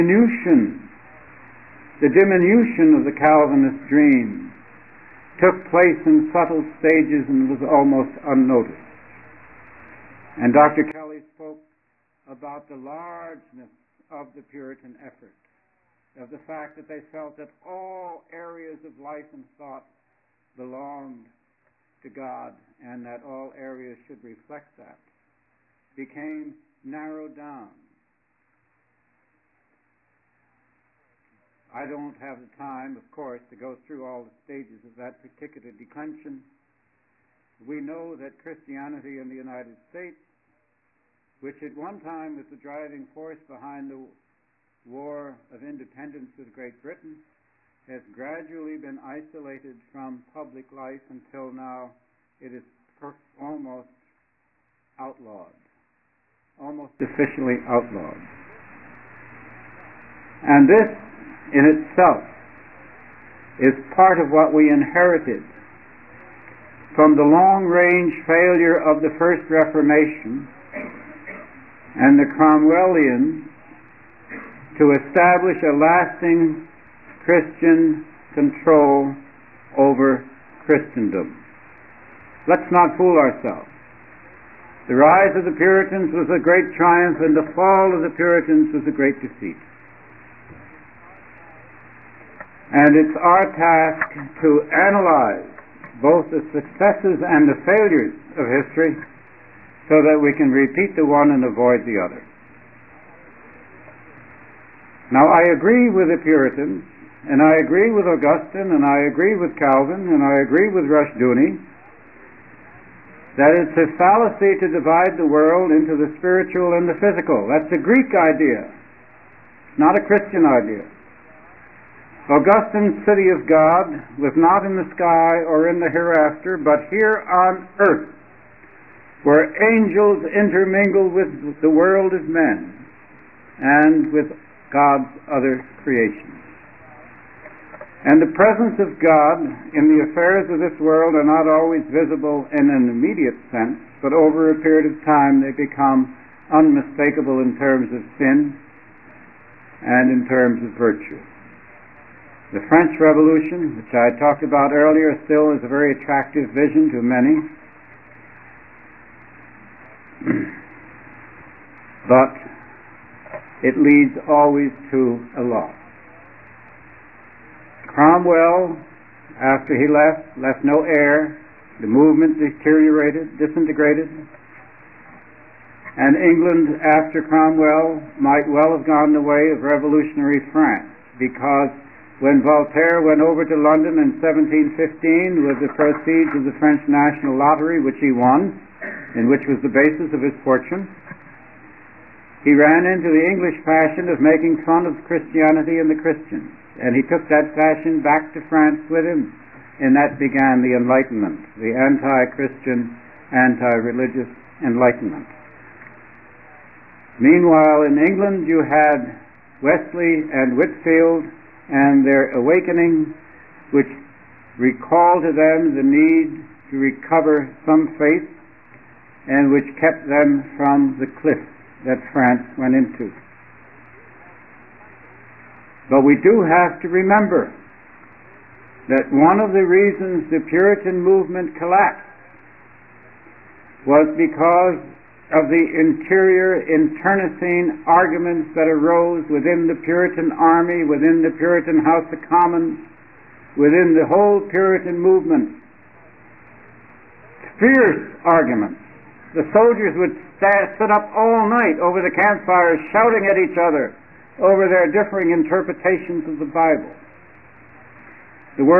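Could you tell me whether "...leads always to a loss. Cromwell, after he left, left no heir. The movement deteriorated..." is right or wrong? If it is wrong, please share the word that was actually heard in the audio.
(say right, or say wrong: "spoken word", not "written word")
right.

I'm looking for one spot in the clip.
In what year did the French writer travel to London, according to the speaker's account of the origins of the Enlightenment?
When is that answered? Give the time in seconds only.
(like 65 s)
184 s.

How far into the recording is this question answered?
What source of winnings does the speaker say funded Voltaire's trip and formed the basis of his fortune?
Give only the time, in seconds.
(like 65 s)
186 s.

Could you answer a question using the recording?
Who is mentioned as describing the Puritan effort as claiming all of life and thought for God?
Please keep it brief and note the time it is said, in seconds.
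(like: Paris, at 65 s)
Dr. Kelly, at 10 s.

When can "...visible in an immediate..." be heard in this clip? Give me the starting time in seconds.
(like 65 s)
141 s.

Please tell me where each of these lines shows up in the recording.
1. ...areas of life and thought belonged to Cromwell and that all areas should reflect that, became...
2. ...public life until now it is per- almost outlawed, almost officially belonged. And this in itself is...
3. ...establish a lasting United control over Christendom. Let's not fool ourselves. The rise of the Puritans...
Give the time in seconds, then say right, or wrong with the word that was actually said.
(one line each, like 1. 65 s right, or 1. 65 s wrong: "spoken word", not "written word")
1. 18 s wrong: "God", not "Cromwell"
2. 50 s wrong: "outlawed", not "belonged"
3. 75 s wrong: "Christian", not "United".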